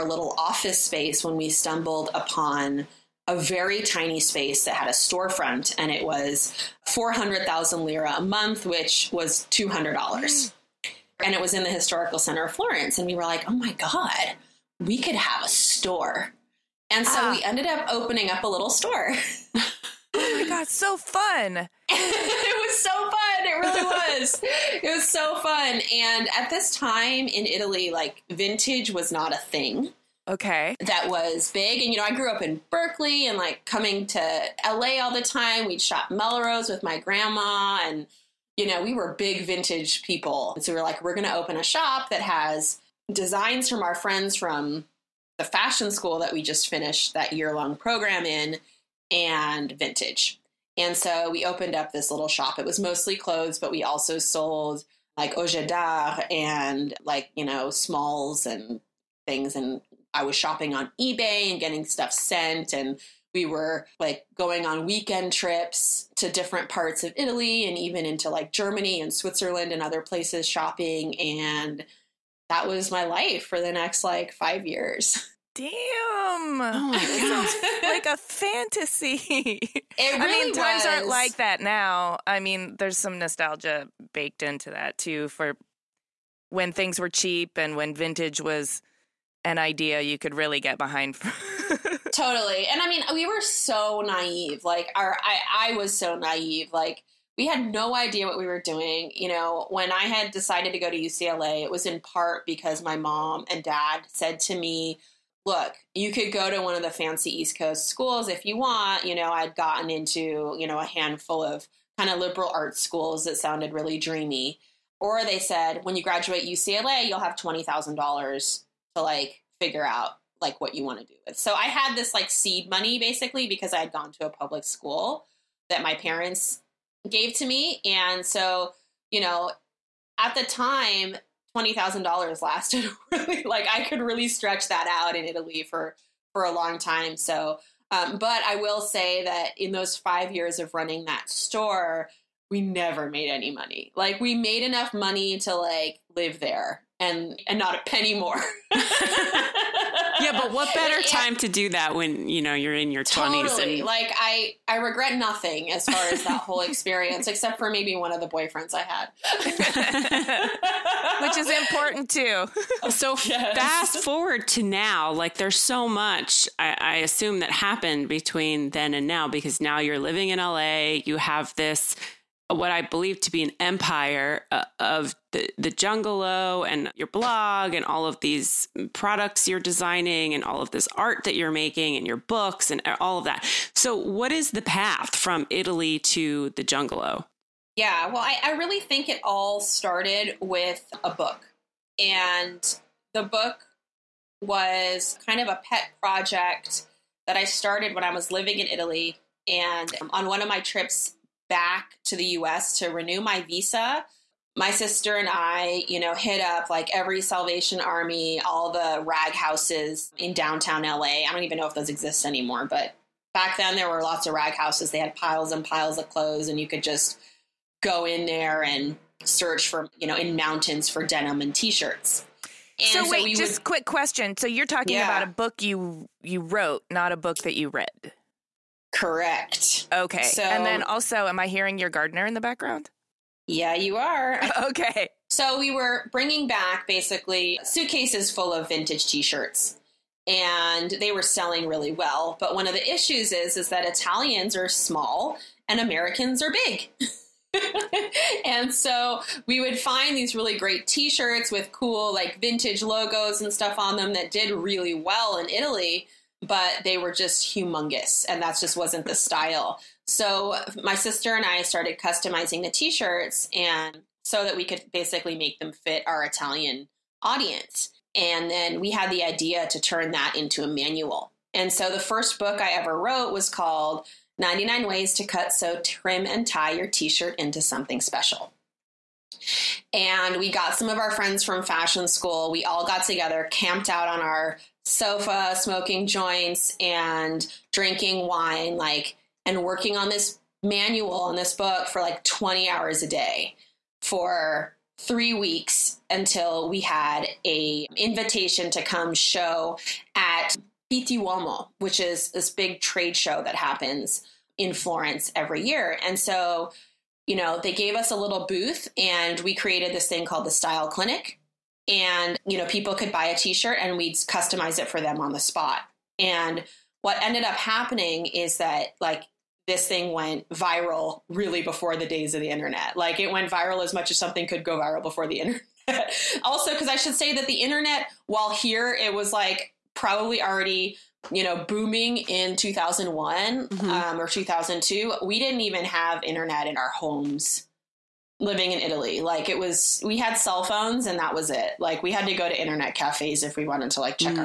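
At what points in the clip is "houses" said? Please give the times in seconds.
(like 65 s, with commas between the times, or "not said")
209 s, 214 s.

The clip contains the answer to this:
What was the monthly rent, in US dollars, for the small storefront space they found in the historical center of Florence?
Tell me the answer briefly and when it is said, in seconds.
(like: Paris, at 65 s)
$200, at 9 s.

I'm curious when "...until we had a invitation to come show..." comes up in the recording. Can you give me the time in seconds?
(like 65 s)
296 s.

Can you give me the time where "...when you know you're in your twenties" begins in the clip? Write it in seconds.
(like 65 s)
151 s.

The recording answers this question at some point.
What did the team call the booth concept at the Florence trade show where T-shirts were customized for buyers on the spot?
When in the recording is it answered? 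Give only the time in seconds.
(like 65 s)
310 s.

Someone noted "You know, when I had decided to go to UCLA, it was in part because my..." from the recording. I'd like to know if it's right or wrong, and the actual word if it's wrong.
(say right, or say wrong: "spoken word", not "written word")
right.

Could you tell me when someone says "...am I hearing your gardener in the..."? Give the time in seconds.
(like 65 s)
231 s.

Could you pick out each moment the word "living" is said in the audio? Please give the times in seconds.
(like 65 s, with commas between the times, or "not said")
169 s, 198 s, 338 s.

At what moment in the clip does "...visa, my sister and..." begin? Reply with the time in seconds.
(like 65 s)
203 s.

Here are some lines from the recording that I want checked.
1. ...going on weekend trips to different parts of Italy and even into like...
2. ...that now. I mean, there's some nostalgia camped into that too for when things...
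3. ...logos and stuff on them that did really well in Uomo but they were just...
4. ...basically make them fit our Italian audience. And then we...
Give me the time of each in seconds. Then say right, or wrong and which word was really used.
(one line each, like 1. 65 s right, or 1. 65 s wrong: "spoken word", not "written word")
1. 64 s right
2. 81 s wrong: "baked", not "camped"
3. 252 s wrong: "Italy", not "Uomo"
4. 264 s right.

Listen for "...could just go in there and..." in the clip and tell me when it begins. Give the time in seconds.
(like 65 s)
216 s.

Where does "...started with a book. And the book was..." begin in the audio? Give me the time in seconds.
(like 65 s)
189 s.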